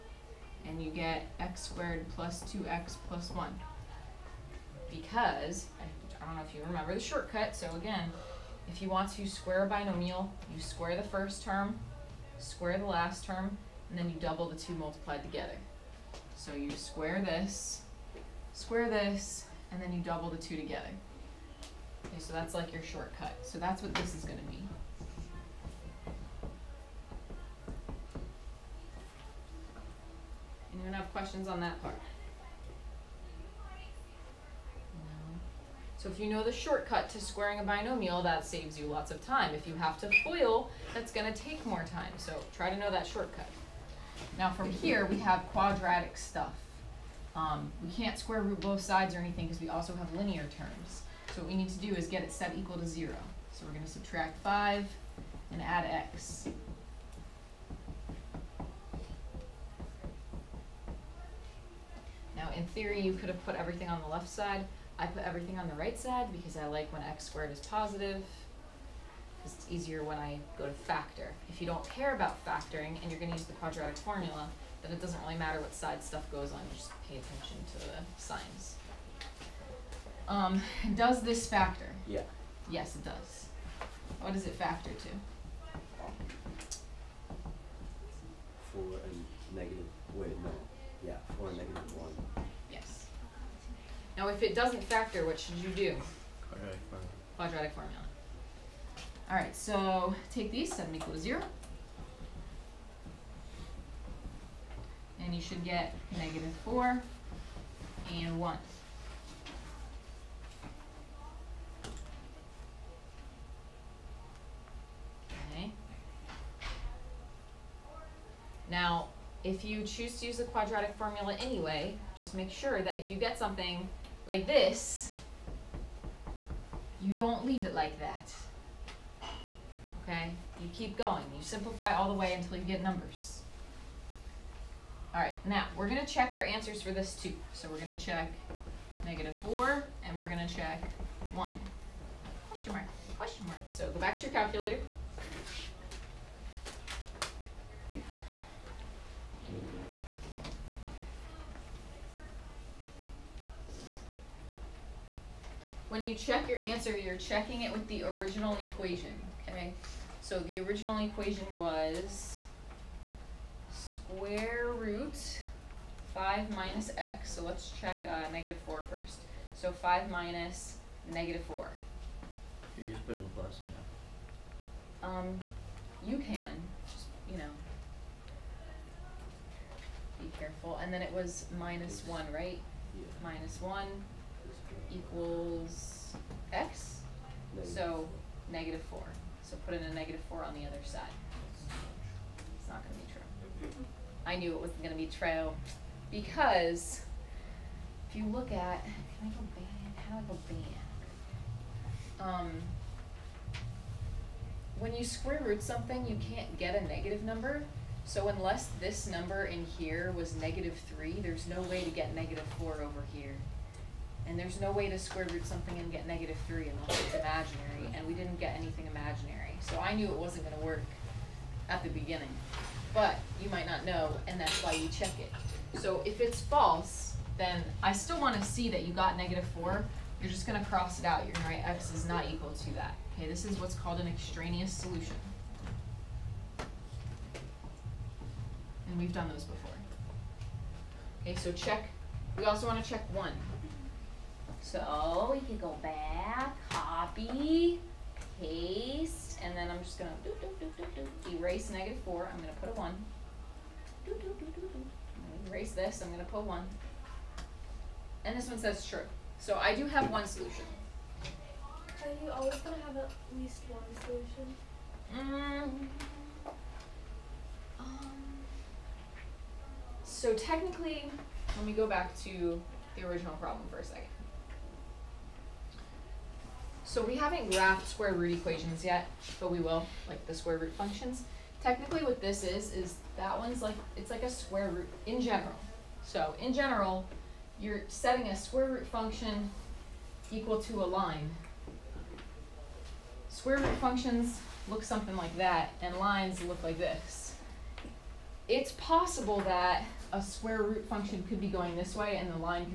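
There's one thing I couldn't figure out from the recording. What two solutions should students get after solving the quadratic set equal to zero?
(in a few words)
-4 and 1.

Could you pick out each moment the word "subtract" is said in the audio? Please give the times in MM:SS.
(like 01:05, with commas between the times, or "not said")
00:53.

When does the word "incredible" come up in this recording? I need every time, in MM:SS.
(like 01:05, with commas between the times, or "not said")
not said.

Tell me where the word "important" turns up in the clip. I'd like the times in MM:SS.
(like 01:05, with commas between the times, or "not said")
not said.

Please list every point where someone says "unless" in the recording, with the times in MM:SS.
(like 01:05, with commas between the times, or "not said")
03:28, 03:36.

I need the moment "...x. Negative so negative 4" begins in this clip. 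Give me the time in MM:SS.
03:06.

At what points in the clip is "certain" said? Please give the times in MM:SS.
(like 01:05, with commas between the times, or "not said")
not said.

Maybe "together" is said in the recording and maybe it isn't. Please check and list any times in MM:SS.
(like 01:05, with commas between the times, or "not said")
00:15, 00:20.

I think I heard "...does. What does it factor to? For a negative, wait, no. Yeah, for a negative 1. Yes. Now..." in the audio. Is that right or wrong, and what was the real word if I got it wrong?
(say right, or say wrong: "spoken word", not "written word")
right.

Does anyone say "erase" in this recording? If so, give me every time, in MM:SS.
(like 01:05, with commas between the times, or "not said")
04:11, 04:15.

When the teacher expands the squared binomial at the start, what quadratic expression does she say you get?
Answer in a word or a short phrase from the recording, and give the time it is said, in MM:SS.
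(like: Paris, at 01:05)
x squared plus 2x plus 1, at 00:01.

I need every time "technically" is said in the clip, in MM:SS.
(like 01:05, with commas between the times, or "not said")
04:30, 04:41.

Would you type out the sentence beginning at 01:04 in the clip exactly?
I put everything on the right side because I like when x squared is positive it's easier when I go to factor.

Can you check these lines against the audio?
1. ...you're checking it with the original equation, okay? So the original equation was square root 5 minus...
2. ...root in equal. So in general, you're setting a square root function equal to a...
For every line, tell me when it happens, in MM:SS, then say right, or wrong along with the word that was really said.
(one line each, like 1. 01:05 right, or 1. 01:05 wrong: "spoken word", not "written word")
1. 02:36 right
2. 04:44 wrong: "general", not "equal".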